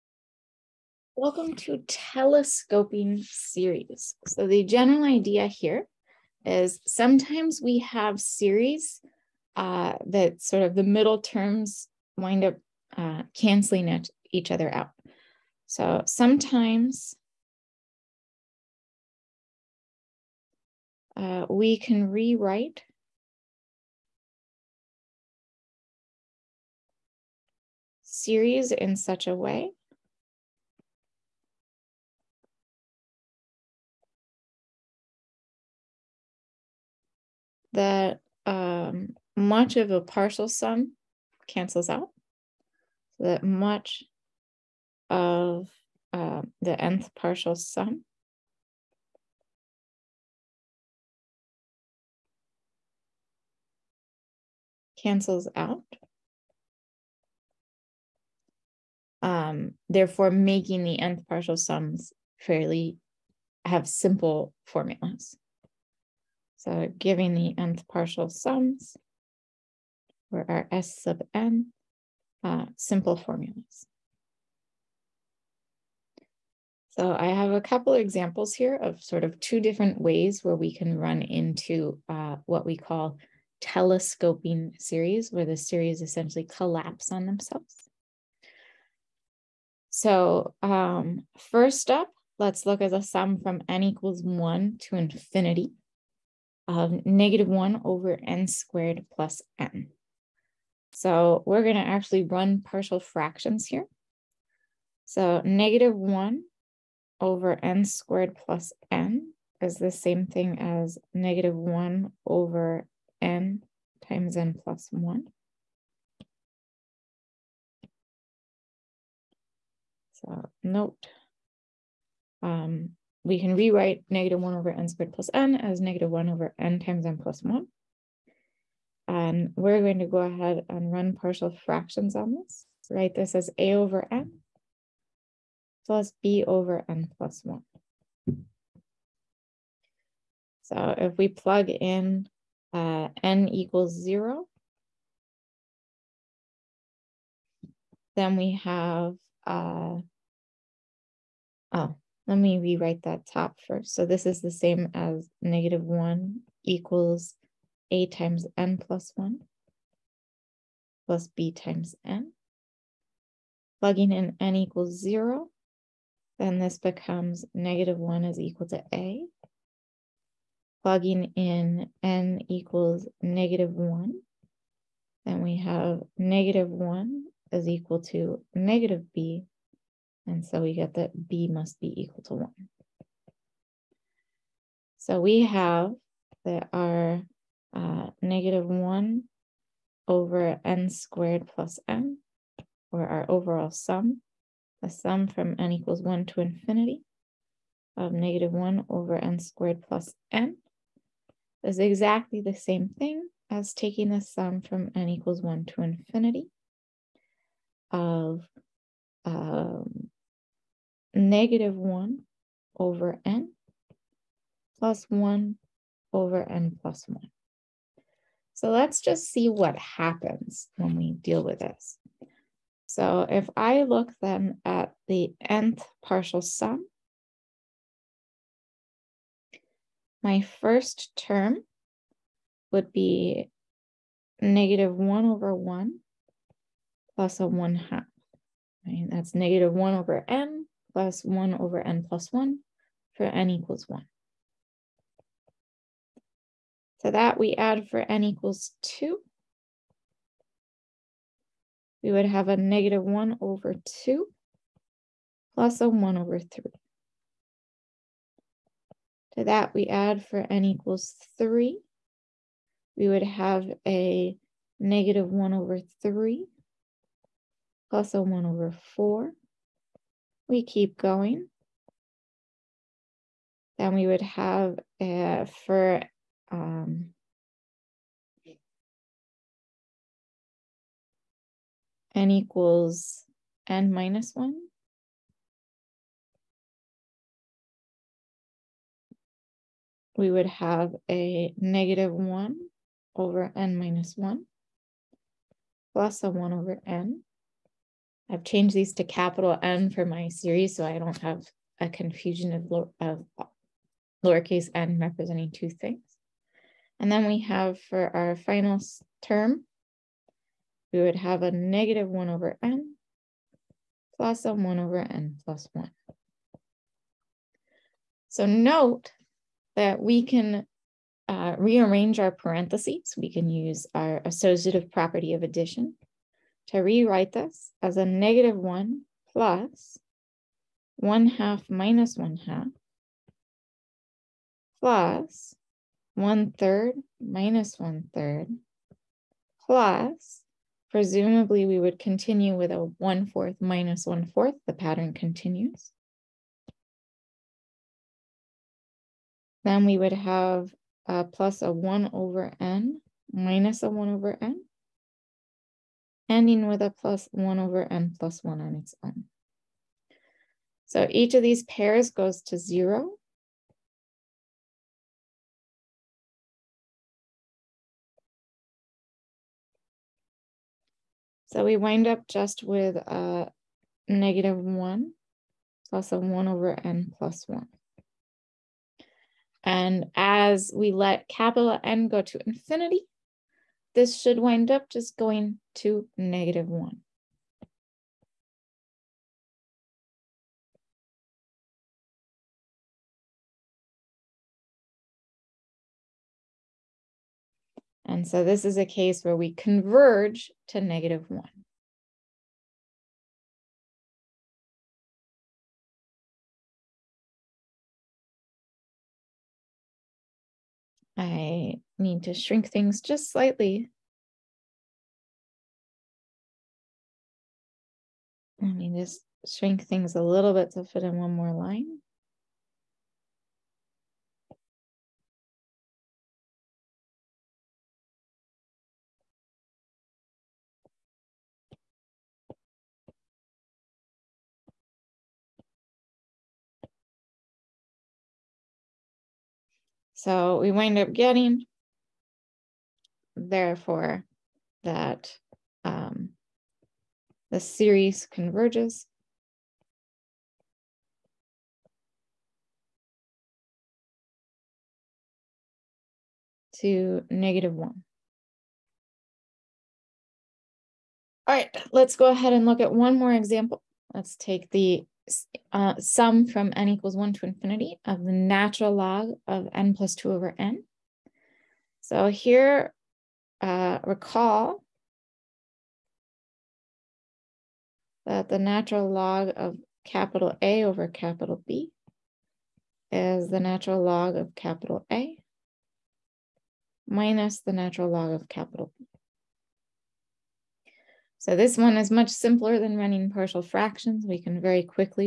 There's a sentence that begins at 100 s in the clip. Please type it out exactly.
So we're going to actually run partial fractions here.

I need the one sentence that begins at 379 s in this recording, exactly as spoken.
And as we let capital N go to infinity, this should wind up just going to negative one.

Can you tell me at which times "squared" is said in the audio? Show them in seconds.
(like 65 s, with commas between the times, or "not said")
98 s, 107 s, 124 s, 190 s, 199 s.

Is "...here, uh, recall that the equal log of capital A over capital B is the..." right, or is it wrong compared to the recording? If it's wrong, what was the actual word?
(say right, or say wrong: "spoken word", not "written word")
wrong: "natural", not "equal".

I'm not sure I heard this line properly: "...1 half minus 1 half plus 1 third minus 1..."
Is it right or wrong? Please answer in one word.
right.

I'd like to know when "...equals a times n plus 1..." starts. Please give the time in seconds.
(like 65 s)
156 s.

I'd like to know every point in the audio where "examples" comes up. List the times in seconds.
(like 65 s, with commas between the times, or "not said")
77 s, 463 s.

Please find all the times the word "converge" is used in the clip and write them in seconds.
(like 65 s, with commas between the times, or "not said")
399 s, 448 s.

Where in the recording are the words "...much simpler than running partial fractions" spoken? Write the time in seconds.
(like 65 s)
492 s.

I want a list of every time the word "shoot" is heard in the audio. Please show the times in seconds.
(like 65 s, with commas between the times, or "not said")
not said.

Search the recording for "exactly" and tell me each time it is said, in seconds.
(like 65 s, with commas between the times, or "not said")
201 s.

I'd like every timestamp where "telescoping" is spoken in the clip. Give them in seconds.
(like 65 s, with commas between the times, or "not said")
1 s, 83 s.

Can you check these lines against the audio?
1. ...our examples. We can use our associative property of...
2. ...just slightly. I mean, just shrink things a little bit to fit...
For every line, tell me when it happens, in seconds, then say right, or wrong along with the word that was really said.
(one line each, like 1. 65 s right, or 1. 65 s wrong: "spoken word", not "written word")
1. 322 s wrong: "parentheses", not "examples"
2. 413 s right.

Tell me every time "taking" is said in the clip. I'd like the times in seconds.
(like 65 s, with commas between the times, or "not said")
203 s.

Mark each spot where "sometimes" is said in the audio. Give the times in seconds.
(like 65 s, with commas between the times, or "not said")
6 s, 16 s.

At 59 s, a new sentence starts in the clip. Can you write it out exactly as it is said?
Um, therefore, making the nth partial sums fairly have simple formulas.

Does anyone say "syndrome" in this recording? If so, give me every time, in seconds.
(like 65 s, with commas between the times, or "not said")
not said.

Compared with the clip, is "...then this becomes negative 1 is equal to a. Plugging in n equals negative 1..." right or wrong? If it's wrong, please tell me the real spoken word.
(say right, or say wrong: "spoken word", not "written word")
right.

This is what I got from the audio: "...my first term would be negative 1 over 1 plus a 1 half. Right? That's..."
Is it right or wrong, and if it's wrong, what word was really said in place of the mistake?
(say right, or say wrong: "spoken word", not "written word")
right.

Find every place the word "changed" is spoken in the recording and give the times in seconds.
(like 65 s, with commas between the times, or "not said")
298 s.